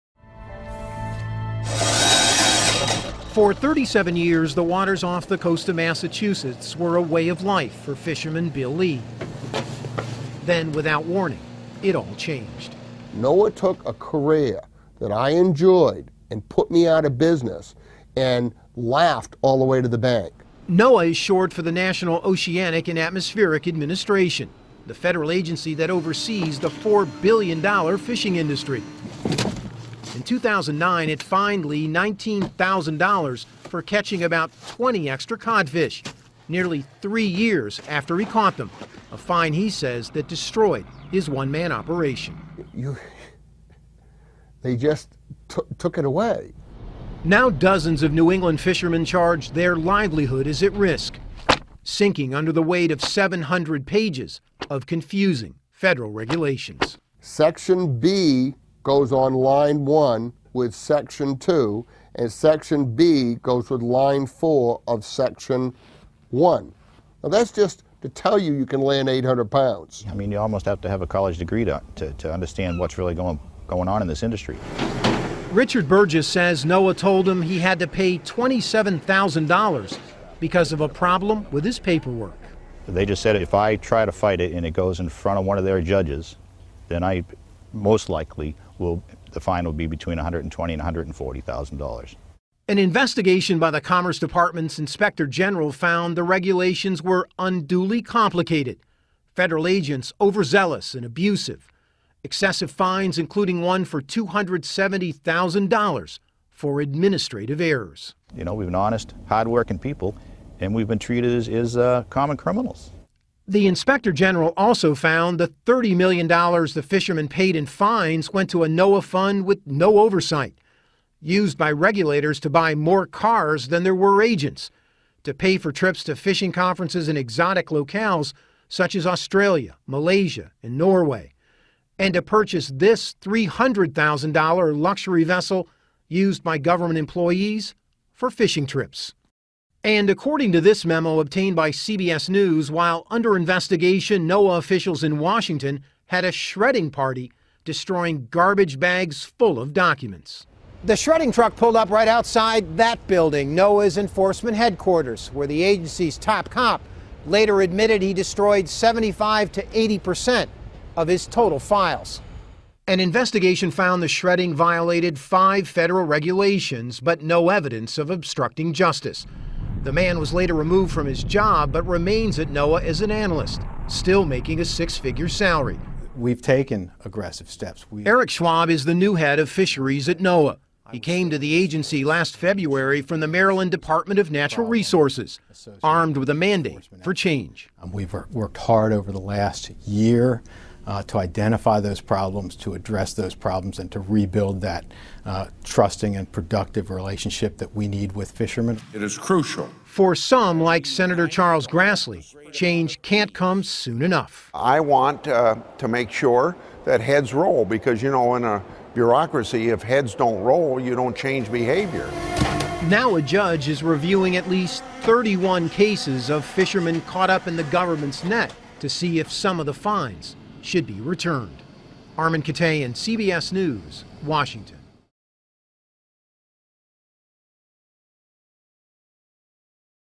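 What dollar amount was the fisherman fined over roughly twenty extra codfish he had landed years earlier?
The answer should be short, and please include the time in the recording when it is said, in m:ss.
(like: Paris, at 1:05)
$19,000, at 0:31.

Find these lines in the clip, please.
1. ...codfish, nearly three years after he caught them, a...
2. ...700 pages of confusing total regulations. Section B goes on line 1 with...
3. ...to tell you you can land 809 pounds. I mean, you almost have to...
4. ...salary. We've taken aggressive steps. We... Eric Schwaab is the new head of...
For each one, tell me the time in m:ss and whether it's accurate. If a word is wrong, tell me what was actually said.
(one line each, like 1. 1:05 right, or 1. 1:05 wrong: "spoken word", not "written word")
1. 0:35 right
2. 0:53 wrong: "federal", not "total"
3. 1:08 wrong: "800", not "809"
4. 2:55 right.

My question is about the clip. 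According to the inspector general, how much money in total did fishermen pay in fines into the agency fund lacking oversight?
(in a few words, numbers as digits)
$30 million.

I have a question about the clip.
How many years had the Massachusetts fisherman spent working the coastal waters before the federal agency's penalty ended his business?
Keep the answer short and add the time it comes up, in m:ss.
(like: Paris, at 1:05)
37, at 0:03.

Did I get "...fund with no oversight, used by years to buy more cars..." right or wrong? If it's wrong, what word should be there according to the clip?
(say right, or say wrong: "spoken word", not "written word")
wrong: "regulators", not "years".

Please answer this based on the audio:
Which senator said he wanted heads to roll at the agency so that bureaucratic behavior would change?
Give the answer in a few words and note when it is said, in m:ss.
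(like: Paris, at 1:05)
Charles Grassley, at 3:21.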